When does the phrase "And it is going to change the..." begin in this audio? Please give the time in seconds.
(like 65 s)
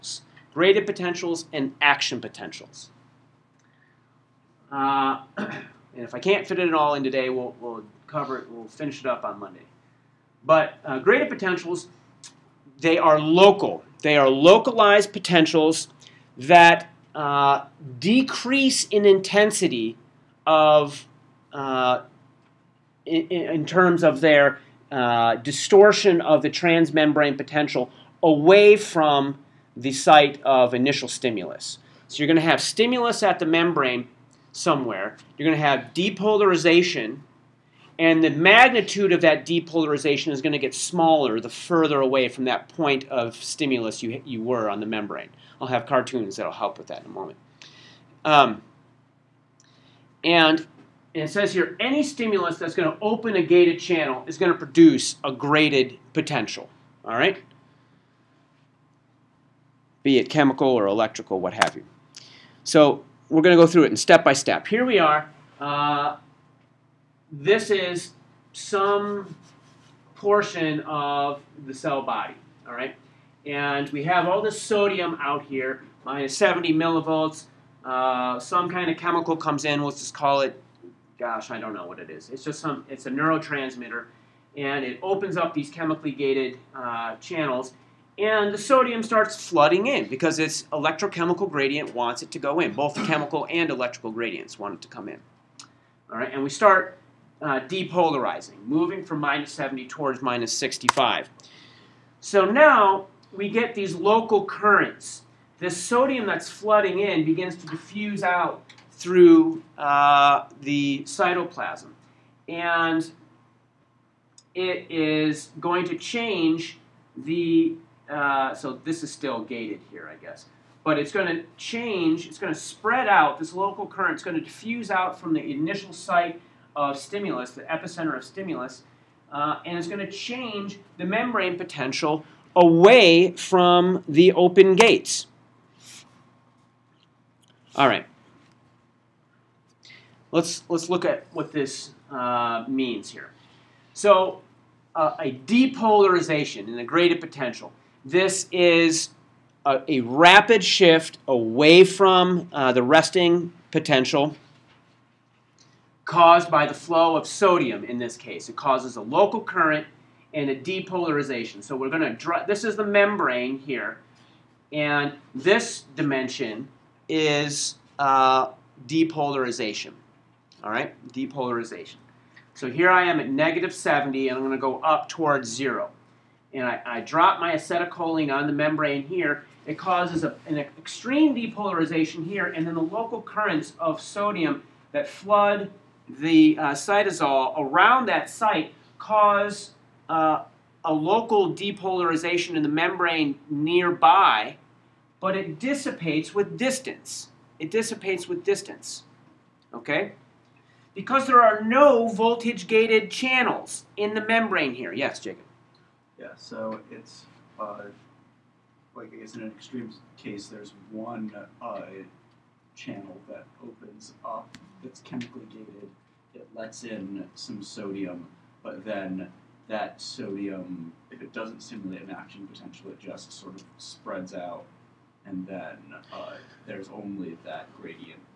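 112 s.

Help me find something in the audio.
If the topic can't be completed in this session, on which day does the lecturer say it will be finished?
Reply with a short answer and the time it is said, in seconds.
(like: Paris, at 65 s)
Monday, at 9 s.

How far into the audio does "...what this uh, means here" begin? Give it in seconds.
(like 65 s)
141 s.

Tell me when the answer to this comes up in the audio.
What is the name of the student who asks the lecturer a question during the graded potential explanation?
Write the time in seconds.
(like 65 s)
205 s.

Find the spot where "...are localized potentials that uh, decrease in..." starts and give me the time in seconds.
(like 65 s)
14 s.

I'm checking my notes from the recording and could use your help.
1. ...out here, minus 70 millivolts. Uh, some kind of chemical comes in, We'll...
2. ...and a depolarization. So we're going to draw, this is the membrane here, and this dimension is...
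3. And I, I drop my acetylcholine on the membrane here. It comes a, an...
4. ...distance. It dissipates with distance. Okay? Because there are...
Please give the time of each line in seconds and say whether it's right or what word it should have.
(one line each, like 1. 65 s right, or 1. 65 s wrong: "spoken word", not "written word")
1. 75 s right
2. 160 s right
3. 176 s wrong: "causes", not "comes"
4. 196 s right.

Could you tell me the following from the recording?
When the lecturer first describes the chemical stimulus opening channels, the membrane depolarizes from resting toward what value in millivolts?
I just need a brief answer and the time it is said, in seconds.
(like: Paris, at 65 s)
-65, at 100 s.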